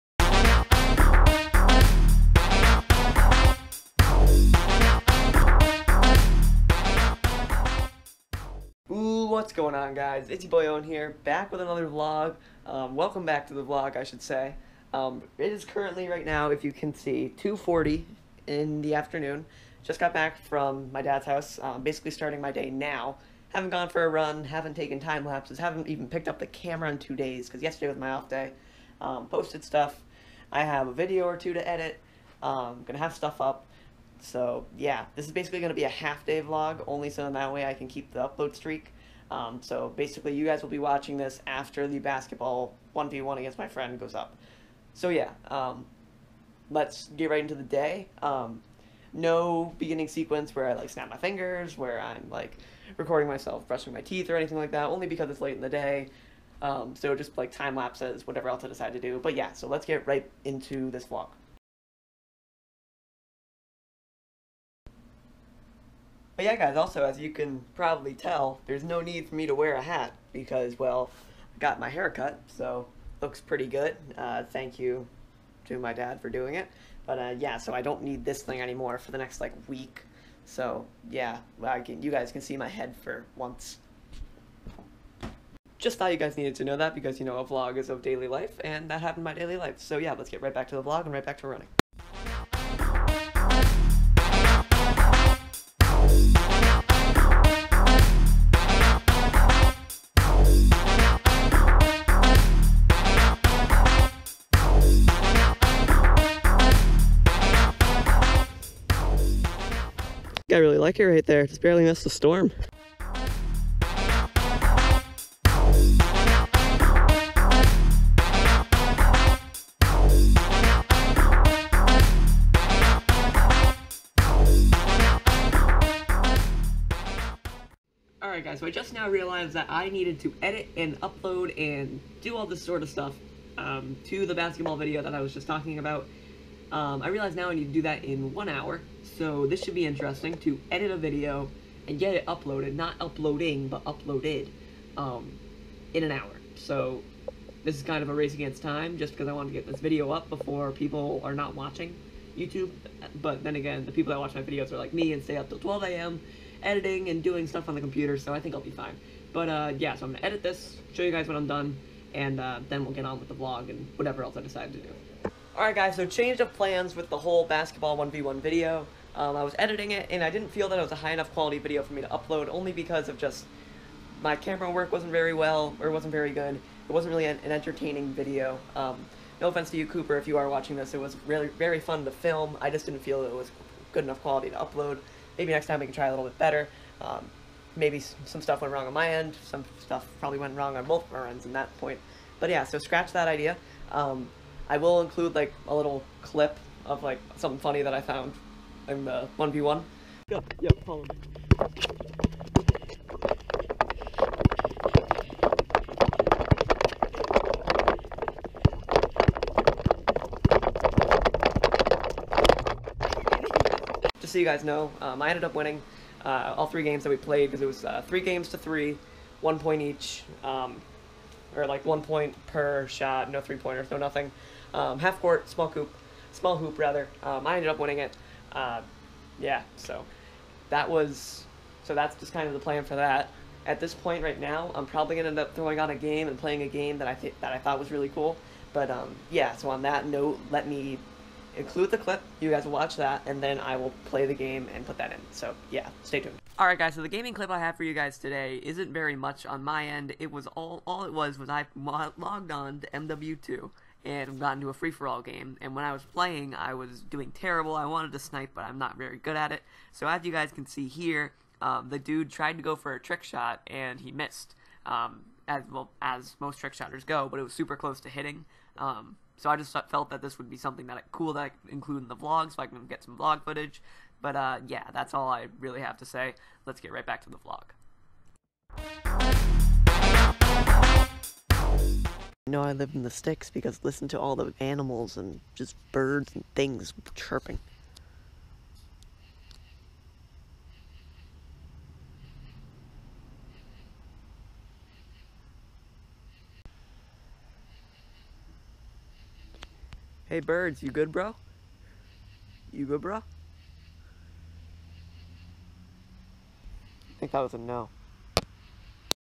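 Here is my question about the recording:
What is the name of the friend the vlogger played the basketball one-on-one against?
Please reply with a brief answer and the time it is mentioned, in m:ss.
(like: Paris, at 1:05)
Cooper, at 2:59.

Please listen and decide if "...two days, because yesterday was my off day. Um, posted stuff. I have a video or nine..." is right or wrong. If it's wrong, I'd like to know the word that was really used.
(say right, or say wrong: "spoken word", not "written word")
wrong: "two", not "nine".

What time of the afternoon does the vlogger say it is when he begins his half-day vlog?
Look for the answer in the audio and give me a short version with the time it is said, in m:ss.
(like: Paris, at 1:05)
2:40, at 0:17.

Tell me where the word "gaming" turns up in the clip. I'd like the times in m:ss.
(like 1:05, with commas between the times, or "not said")
4:07.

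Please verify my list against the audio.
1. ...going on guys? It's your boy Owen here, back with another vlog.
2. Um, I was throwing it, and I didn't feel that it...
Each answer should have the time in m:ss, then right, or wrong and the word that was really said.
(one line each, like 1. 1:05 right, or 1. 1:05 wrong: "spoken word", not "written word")
1. 0:09 right
2. 2:49 wrong: "editing", not "throwing".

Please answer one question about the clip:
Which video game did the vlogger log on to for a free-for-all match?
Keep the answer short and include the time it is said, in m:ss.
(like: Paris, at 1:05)
MW2, at 4:12.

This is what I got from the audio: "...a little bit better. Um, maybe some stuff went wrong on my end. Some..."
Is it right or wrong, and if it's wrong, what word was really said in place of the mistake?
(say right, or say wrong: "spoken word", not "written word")
right.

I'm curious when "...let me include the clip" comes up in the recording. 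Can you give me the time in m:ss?
4:00.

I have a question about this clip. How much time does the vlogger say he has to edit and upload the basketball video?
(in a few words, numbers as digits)
1 hour.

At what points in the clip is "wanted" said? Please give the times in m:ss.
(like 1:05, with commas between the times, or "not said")
2:29, 4:17.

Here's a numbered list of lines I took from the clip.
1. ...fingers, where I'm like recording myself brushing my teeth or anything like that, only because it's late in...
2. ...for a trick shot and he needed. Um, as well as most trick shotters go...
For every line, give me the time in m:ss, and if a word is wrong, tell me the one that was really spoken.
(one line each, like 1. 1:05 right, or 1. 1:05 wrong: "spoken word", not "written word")
1. 0:51 right
2. 4:22 wrong: "missed", not "needed".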